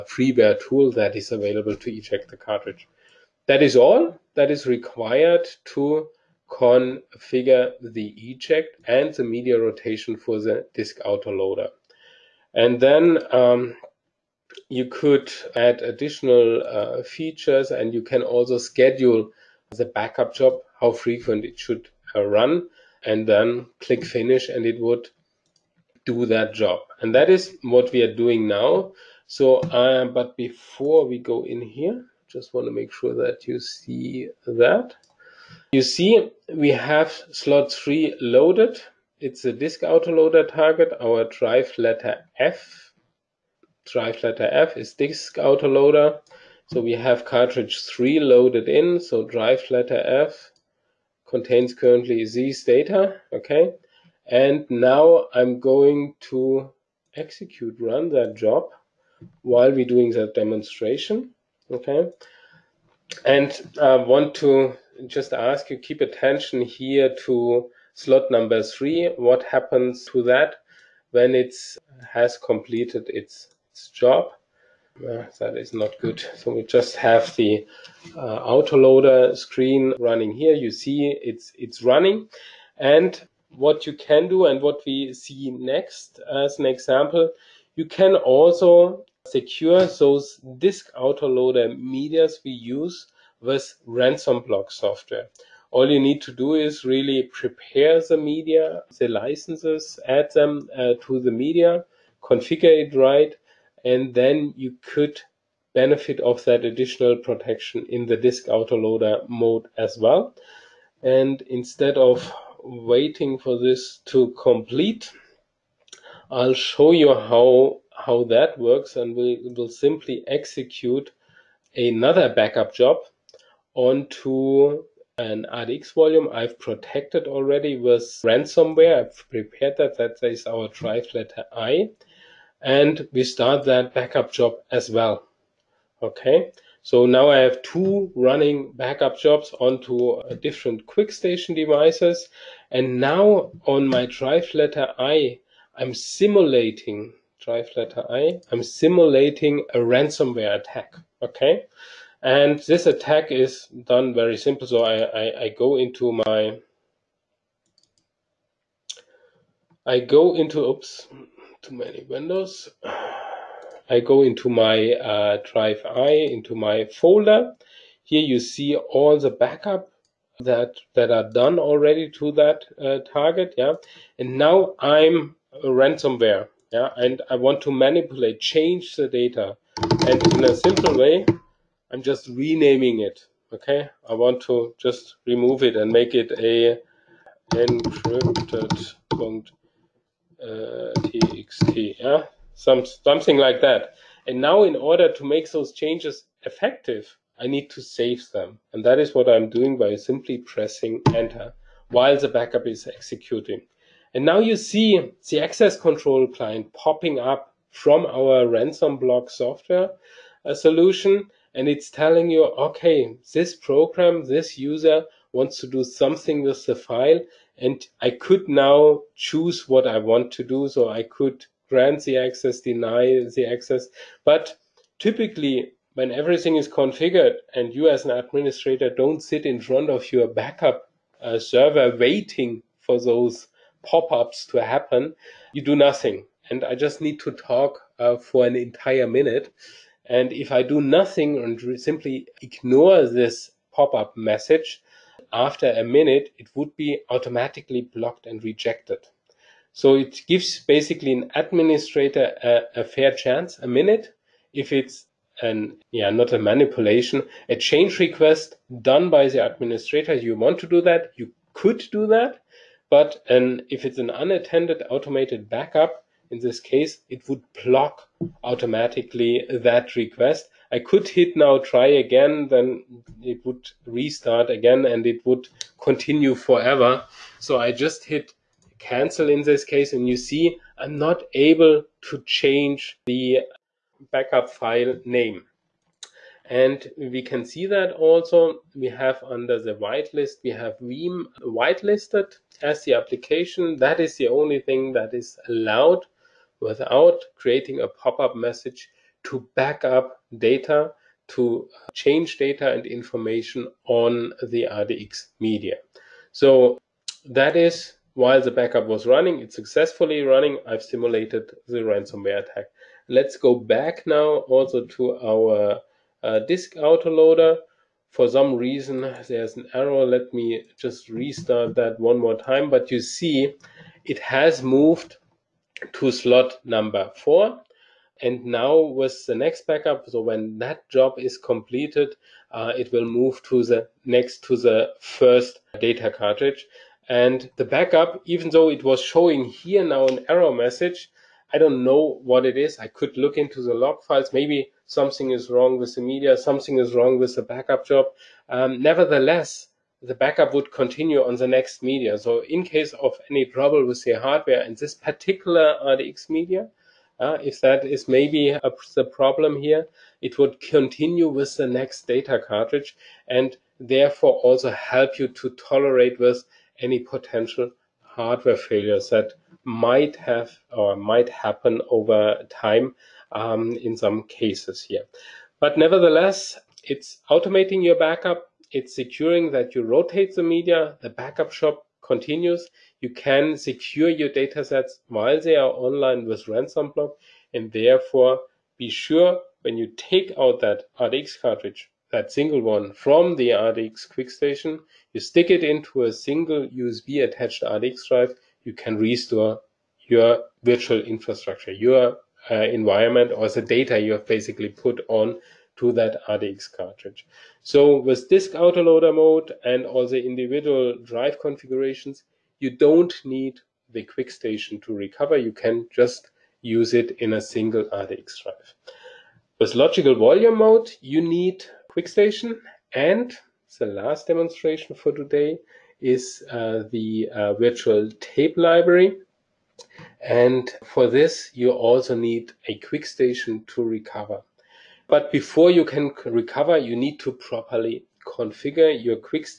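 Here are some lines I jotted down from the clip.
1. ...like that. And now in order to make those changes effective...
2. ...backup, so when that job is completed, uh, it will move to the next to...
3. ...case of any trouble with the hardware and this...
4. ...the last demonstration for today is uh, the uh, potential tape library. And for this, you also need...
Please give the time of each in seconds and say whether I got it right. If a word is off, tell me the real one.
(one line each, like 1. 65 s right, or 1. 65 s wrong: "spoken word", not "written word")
1. 193 s right
2. 329 s right
3. 352 s right
4. 423 s wrong: "virtual", not "potential".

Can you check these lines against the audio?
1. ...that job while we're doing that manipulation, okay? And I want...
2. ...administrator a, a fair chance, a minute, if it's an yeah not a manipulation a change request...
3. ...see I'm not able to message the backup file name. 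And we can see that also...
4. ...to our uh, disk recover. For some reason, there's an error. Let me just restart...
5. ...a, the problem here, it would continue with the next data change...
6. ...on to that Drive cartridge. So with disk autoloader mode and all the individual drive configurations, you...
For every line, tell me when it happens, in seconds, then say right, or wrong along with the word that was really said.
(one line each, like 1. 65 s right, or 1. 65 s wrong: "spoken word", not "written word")
1. 58 s wrong: "demonstration", not "manipulation"
2. 251 s right
3. 280 s wrong: "change", not "message"
4. 314 s wrong: "autoloader", not "recover"
5. 358 s wrong: "cartridge", not "change"
6. 405 s wrong: "RDX", not "Drive".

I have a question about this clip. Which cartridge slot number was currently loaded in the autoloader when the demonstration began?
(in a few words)
3.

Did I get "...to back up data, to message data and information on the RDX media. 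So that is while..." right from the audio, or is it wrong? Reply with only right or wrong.
wrong.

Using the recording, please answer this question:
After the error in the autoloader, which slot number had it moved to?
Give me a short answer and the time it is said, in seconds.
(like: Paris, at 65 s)
4, at 326 s.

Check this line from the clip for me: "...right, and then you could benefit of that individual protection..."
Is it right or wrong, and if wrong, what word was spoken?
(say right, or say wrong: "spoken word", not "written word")
wrong: "additional", not "individual".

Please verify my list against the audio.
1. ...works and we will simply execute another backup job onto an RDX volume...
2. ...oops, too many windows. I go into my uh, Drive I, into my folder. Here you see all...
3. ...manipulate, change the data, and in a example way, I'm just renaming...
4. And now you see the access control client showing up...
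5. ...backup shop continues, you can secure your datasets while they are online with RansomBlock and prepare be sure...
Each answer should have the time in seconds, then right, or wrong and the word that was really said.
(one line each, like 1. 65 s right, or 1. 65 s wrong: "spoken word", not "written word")
1. 118 s right
2. 160 s right
3. 177 s wrong: "simple", not "example"
4. 204 s wrong: "popping", not "showing"
5. 381 s wrong: "therefore", not "prepare".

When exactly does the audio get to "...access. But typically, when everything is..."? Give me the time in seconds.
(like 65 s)
223 s.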